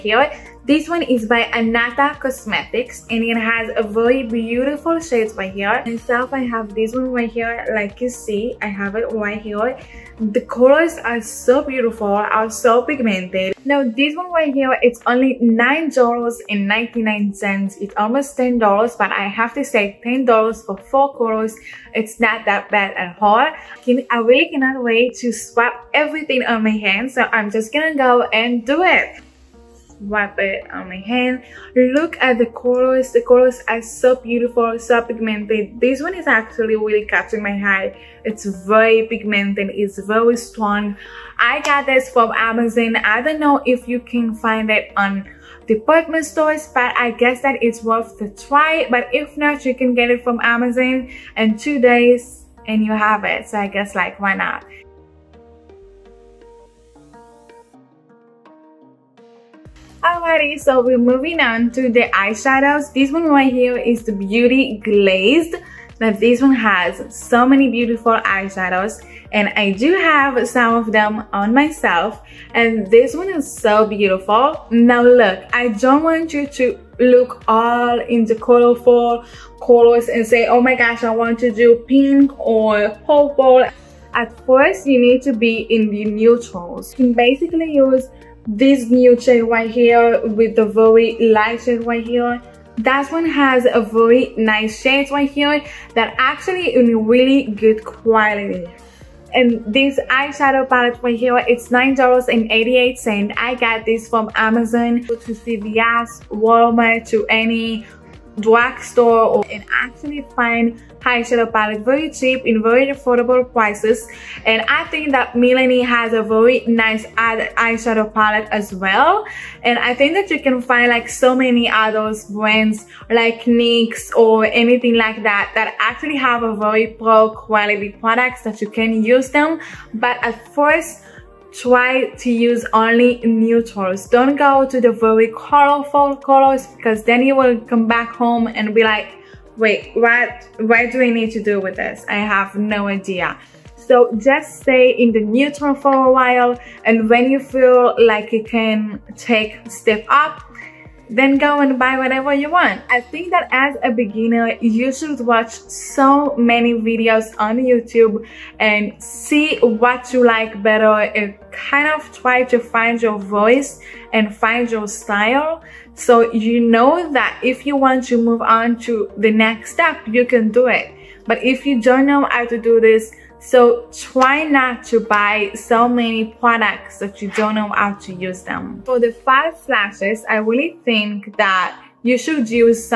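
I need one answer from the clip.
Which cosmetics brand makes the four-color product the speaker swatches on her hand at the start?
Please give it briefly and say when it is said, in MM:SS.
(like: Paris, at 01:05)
Anata Cosmetics, at 00:01.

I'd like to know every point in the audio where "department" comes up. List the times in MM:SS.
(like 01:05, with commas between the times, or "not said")
00:45.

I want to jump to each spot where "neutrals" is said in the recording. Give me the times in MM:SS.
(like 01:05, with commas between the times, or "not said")
01:26, 02:13, 02:25.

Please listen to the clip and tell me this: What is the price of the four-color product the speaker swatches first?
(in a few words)
$9.99.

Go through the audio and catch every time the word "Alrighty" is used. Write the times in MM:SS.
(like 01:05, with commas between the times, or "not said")
01:00.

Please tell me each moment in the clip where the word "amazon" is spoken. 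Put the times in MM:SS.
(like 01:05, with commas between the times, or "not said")
00:42, 00:50, 01:44.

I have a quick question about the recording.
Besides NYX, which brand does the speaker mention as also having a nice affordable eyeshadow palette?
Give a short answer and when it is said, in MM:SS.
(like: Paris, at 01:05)
Milani, at 01:55.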